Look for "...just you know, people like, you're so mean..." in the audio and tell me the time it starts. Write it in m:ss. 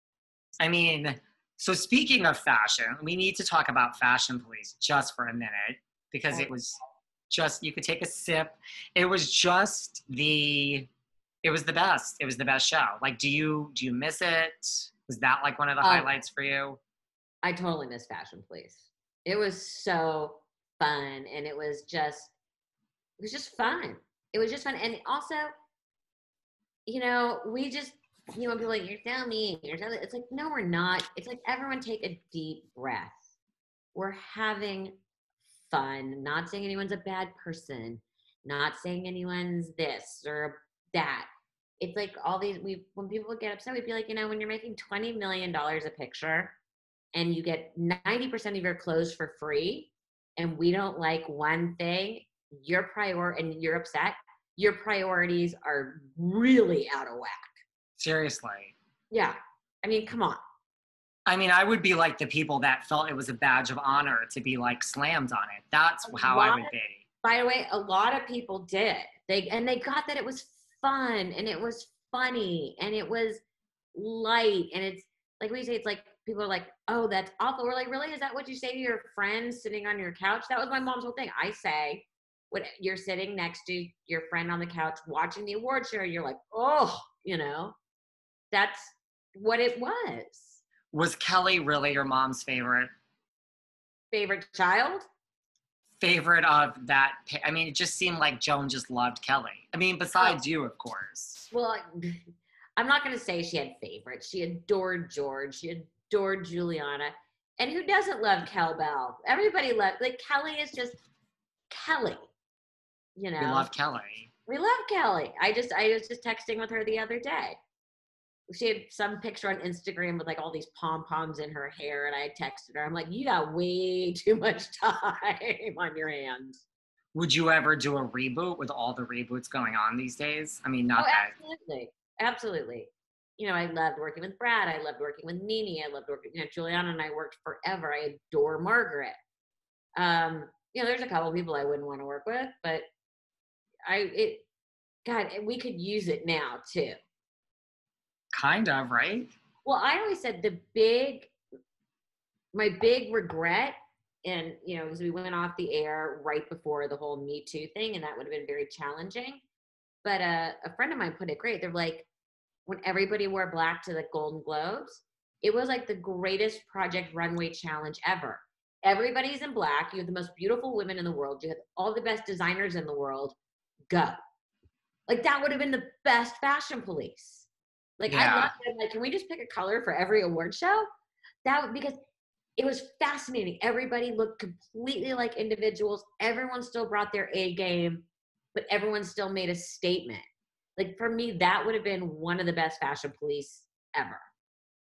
0:27.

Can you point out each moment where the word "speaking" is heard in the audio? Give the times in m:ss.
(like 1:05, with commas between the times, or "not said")
0:01.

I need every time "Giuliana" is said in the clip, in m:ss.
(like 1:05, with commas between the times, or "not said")
1:46, 2:16.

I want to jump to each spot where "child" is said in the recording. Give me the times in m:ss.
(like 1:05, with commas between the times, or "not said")
1:34.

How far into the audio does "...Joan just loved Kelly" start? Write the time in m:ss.
1:38.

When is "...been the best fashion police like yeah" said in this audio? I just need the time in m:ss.
2:55.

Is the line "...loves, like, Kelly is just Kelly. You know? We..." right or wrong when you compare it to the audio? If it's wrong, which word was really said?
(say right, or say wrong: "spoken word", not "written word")
right.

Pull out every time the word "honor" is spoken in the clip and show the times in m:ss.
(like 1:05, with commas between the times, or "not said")
1:03.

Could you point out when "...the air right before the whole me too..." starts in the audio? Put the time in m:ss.
2:35.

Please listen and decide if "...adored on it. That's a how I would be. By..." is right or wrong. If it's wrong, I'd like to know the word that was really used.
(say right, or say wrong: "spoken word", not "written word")
wrong: "slammed", not "adored".